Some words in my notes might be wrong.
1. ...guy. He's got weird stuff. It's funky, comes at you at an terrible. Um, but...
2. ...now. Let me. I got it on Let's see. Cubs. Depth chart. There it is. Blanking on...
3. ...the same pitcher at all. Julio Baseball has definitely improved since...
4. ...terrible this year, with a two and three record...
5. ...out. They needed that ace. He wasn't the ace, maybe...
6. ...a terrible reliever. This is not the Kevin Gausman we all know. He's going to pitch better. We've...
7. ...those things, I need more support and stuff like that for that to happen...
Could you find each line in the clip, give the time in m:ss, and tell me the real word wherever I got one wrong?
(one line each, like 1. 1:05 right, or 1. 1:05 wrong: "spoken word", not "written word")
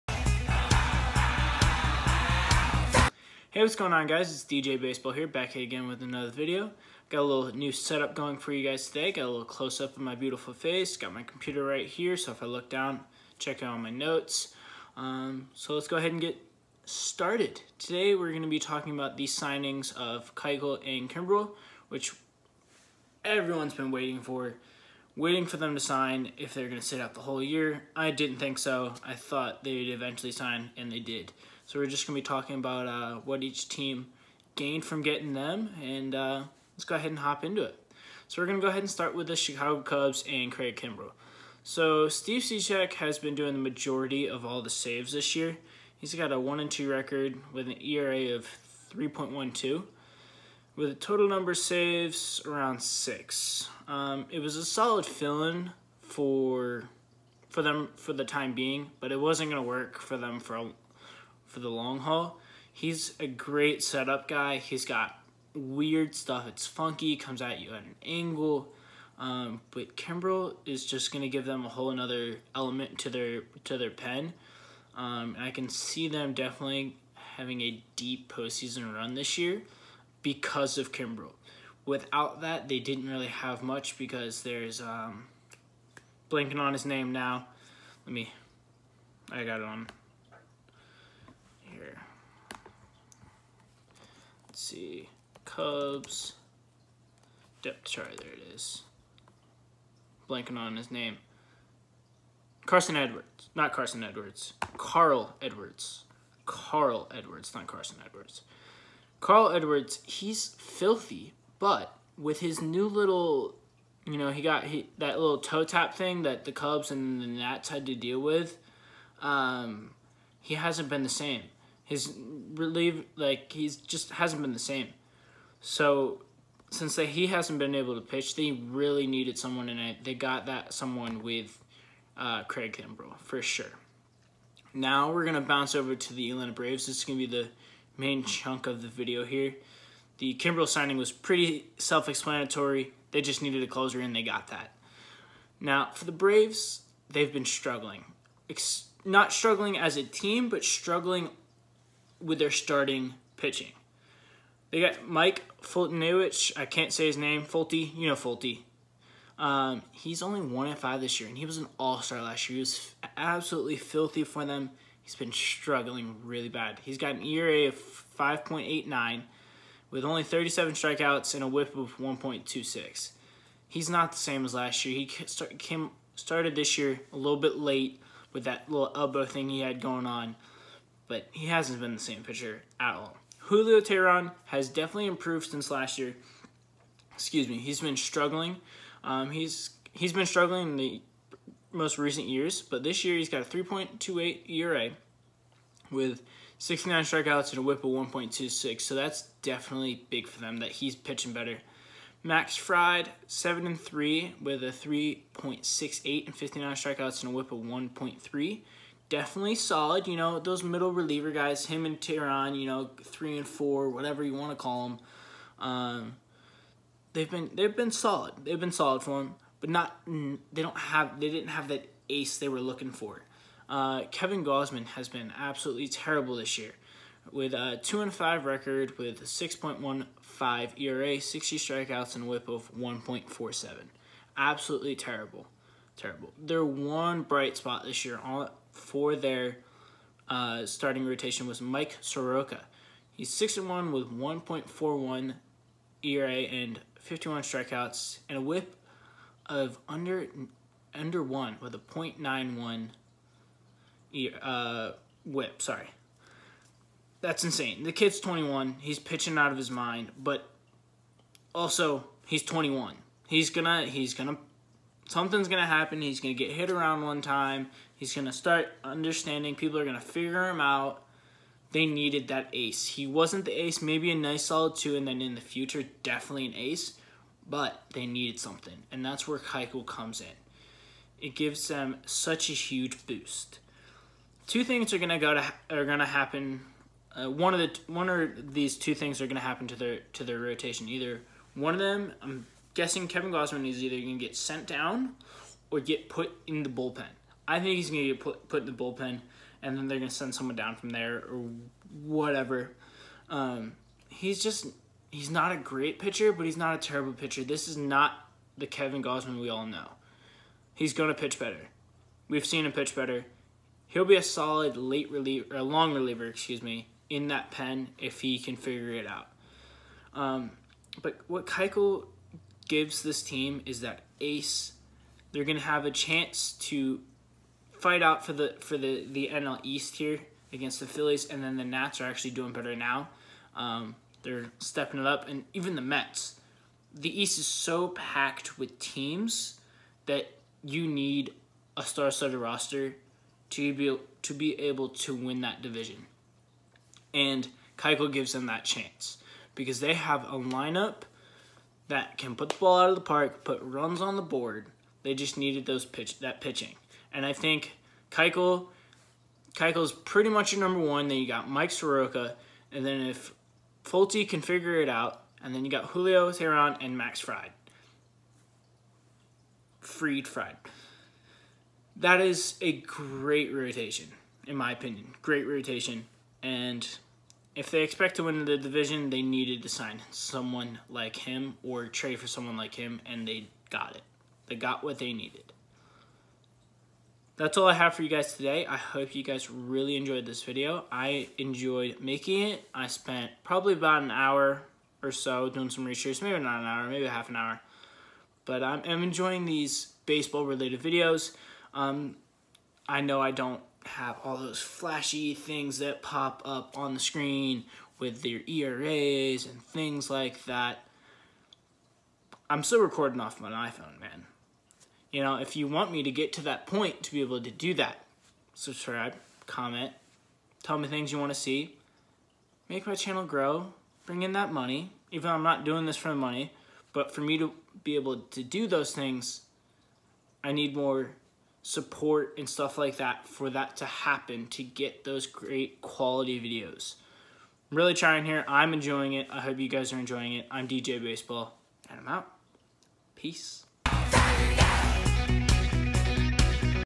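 1. 1:04 wrong: "angle", not "terrible"
2. 1:27 right
3. 3:01 wrong: "Teheran", not "Baseball"
4. 3:45 wrong: "five", not "three"
5. 4:30 right
6. 5:06 wrong: "pitcher", not "reliever"
7. 7:08 right.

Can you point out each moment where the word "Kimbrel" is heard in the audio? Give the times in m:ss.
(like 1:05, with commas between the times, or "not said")
0:21, 0:40, 1:09, 1:20, 2:12, 2:20.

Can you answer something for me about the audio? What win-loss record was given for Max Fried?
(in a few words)
7 and 3.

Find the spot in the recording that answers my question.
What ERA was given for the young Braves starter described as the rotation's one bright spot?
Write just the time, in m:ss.
4:04.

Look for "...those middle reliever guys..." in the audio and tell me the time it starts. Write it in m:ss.
3:30.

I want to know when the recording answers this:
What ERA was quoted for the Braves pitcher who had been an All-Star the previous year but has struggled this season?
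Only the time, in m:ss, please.
2:48.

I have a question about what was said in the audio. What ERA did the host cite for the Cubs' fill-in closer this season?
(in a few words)
3.12.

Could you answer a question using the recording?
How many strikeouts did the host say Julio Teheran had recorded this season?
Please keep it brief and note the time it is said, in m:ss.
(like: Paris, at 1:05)
69, at 3:16.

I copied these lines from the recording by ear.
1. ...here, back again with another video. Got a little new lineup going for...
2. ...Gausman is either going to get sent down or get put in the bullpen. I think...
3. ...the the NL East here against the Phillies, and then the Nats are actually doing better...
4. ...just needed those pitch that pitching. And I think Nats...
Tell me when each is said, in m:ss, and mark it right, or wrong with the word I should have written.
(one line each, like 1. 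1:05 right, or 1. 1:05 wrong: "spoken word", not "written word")
1. 0:05 wrong: "setup", not "lineup"
2. 4:53 right
3. 5:28 right
4. 5:55 wrong: "Keuchel", not "Nats".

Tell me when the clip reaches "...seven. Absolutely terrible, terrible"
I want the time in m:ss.
3:53.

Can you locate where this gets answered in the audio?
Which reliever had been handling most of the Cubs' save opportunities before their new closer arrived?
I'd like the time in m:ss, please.
0:42.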